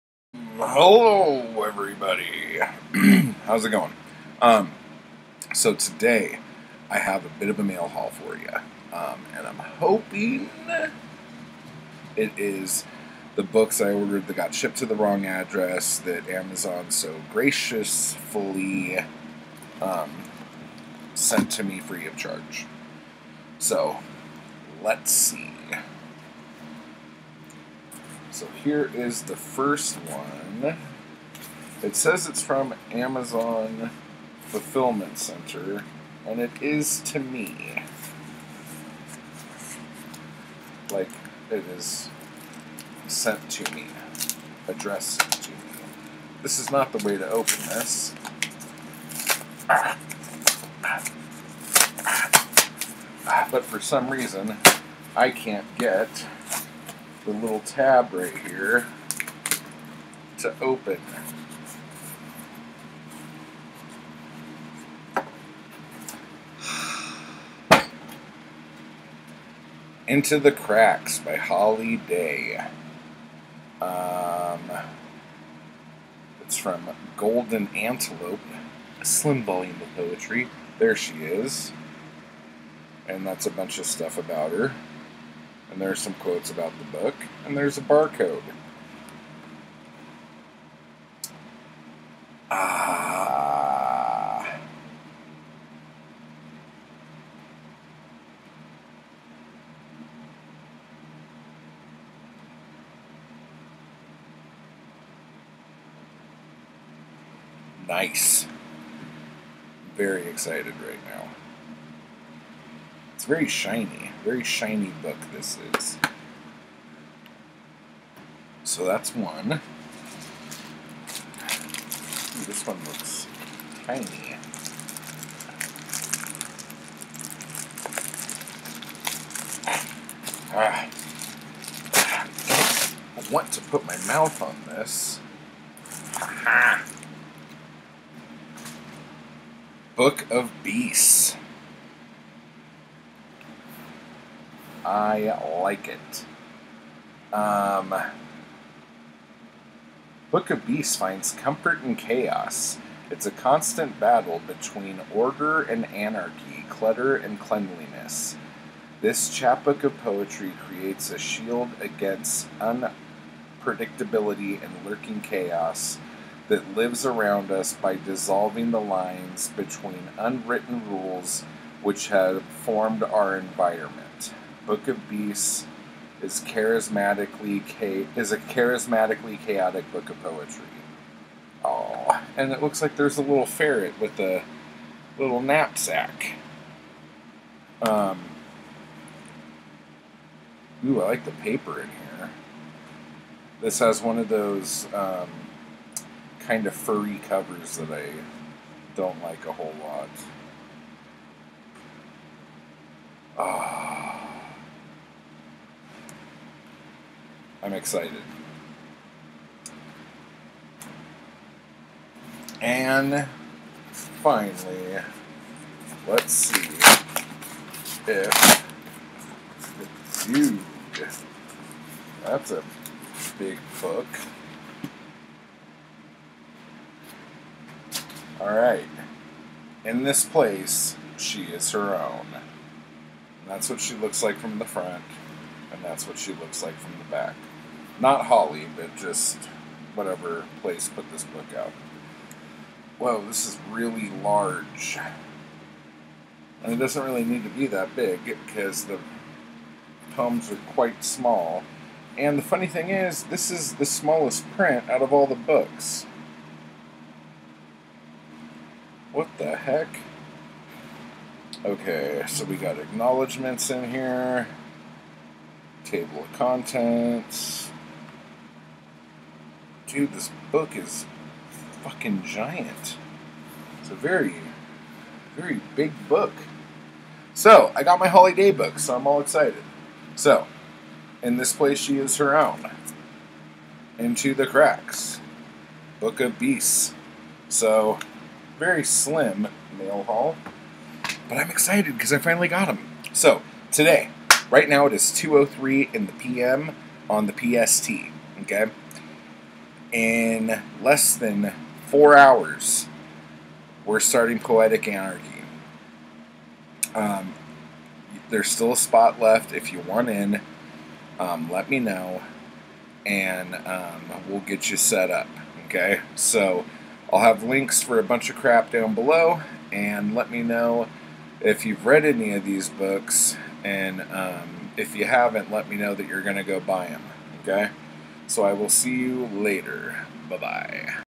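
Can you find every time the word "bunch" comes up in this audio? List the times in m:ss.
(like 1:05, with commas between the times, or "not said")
1:23, 5:18.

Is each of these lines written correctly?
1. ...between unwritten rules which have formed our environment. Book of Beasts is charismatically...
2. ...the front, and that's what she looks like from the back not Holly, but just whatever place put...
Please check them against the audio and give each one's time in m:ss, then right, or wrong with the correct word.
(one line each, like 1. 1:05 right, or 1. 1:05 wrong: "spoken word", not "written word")
1. 2:49 right
2. 3:54 right.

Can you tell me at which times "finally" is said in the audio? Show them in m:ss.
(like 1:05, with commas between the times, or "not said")
3:34, 4:52.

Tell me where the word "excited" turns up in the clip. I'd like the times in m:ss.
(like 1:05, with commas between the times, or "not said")
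1:50, 3:27, 4:39, 4:51.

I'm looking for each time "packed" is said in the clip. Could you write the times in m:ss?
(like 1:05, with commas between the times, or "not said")
not said.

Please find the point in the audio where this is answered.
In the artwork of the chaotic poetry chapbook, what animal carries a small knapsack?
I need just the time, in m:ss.
3:03.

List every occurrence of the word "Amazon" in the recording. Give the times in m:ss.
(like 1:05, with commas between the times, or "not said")
0:16, 0:32.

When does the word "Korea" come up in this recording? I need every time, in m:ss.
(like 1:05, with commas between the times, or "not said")
not said.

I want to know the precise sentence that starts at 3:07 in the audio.
Um, ooh, I like the paper in here.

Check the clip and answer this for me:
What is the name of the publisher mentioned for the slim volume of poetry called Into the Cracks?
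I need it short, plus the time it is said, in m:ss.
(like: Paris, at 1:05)
Golden Antelope, at 1:17.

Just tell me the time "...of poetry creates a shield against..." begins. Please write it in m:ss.
2:39.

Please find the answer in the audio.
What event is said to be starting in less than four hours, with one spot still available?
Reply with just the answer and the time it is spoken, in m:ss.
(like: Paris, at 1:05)
Poetic Anarchy, at 5:04.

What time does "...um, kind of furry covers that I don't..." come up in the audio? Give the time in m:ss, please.
3:14.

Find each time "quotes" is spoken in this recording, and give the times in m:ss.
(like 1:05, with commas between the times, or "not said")
1:26.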